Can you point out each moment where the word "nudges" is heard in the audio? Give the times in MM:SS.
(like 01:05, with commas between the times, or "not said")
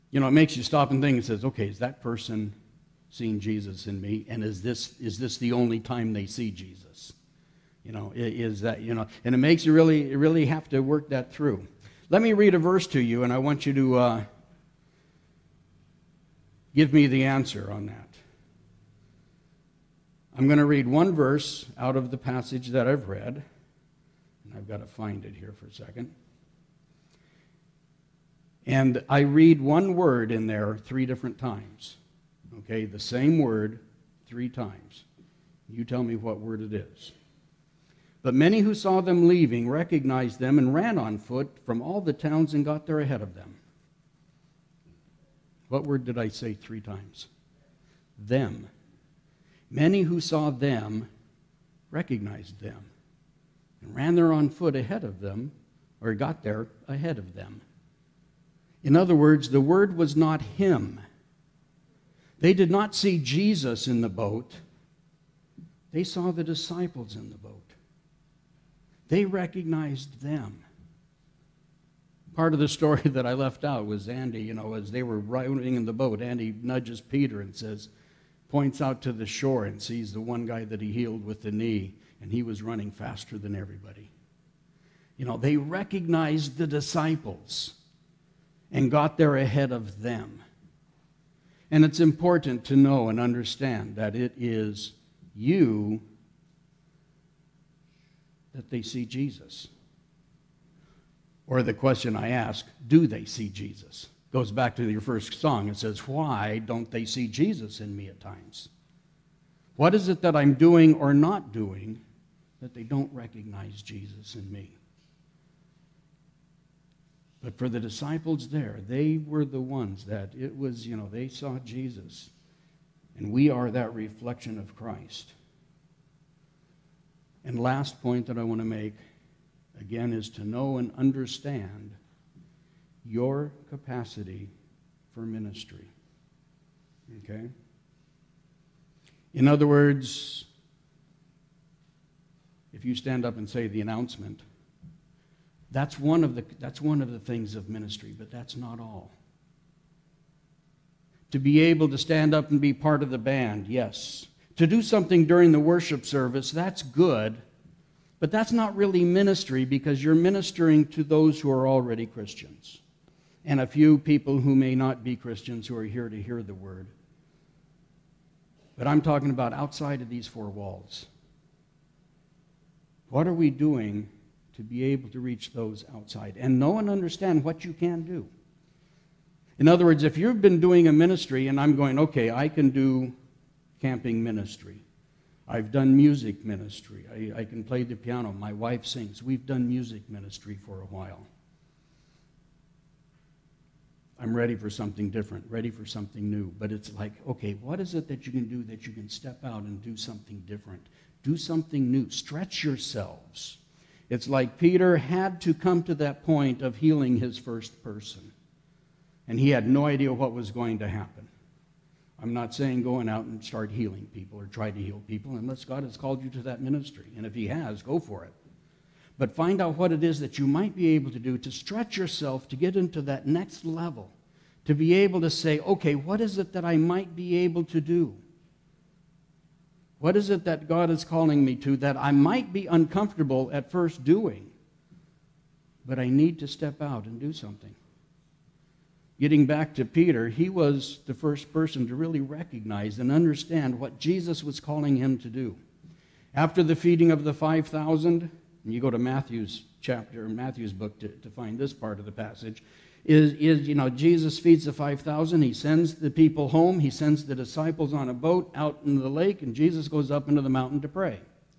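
01:16.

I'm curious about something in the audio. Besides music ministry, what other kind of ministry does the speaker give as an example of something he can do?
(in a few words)
Camping ministry.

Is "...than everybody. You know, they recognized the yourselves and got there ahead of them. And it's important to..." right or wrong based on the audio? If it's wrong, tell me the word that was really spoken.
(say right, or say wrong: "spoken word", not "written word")
wrong: "disciples", not "yourselves".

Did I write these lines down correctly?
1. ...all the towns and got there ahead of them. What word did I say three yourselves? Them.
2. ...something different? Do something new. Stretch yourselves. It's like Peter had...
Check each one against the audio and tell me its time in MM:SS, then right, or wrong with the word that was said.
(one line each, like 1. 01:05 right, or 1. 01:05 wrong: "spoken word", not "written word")
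1. 00:41 wrong: "times", not "yourselves"
2. 03:19 right.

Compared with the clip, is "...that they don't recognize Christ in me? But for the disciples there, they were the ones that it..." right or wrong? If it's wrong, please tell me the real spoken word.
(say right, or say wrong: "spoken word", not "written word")
wrong: "Jesus", not "Christ".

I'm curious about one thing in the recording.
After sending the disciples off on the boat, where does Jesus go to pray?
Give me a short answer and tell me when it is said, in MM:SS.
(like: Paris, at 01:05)
The mountain, at 04:20.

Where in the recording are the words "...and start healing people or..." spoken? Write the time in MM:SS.
03:33.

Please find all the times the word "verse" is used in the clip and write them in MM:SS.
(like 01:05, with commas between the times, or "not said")
00:12, 00:21.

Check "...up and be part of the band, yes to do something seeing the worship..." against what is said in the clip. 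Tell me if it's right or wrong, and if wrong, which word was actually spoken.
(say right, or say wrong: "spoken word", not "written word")
wrong: "during", not "seeing".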